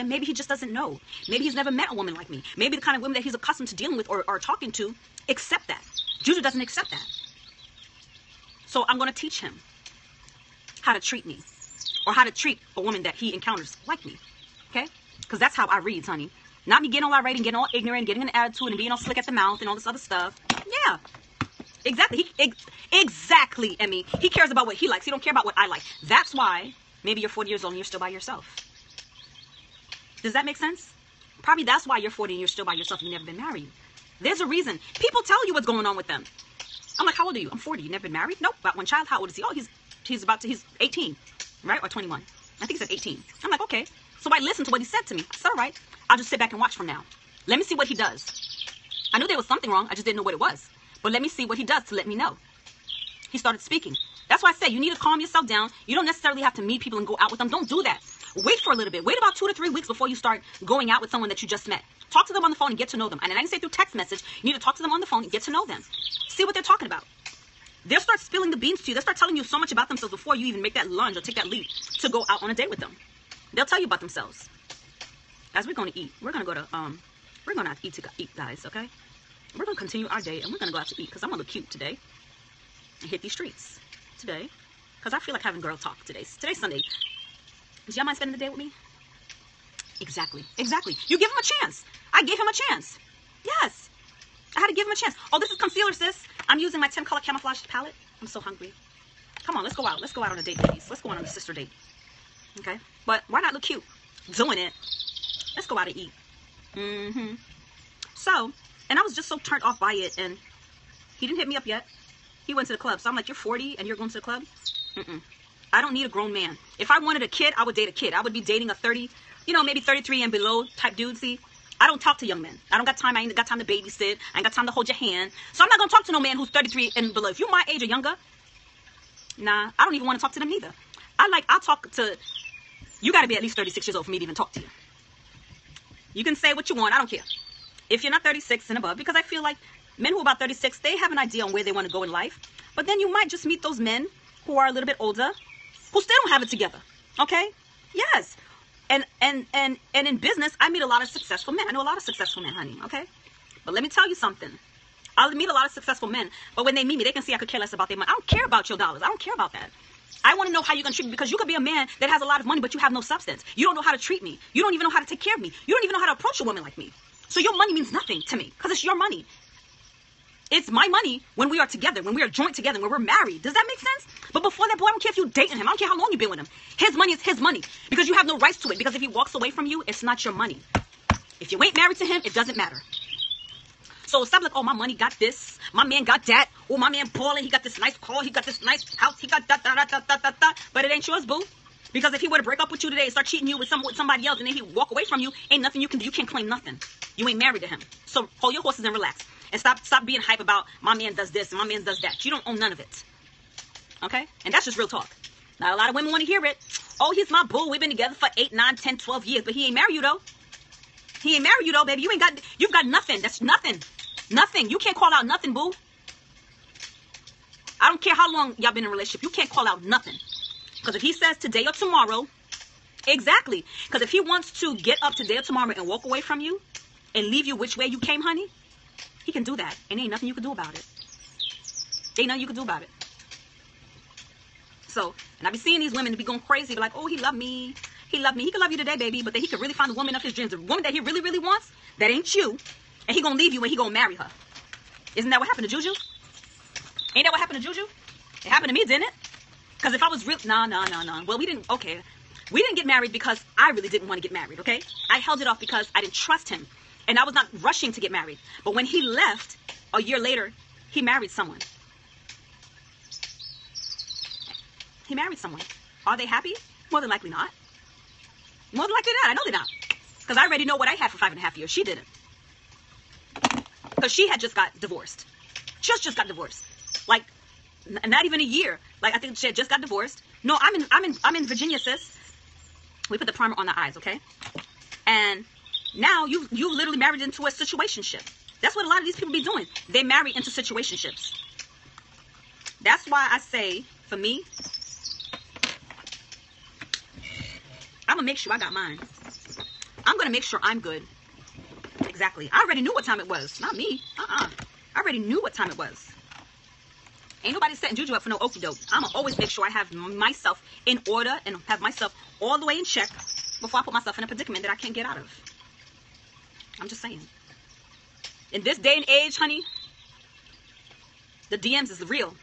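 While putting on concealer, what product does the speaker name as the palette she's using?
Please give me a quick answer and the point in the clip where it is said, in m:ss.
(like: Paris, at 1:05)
10 color camouflage palette, at 1:36.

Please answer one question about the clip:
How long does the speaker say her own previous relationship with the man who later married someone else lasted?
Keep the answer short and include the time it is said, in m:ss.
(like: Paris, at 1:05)
5 and a half years, at 4:31.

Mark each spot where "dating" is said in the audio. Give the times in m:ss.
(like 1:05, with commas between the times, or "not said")
1:58, 2:55.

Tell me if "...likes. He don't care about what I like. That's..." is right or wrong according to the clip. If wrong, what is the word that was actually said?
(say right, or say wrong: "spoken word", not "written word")
right.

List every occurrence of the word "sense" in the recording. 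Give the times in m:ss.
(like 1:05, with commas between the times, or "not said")
0:30, 2:53.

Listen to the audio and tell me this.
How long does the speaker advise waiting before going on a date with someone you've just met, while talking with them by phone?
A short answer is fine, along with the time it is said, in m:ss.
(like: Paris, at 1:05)
2 to 3 weeks, at 0:59.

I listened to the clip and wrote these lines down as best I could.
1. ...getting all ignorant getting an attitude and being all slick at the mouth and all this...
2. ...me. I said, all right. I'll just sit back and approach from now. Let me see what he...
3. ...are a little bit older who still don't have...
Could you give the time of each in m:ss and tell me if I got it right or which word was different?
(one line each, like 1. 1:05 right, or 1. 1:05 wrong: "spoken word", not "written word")
1. 0:17 right
2. 0:45 wrong: "watch", not "approach"
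3. 2:24 right.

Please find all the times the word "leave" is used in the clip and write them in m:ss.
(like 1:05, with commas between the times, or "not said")
3:47, 4:03.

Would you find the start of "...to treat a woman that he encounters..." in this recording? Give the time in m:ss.
0:12.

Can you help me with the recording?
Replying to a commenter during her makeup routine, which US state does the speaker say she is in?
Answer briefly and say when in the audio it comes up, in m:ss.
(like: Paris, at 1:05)
Virginia, at 4:41.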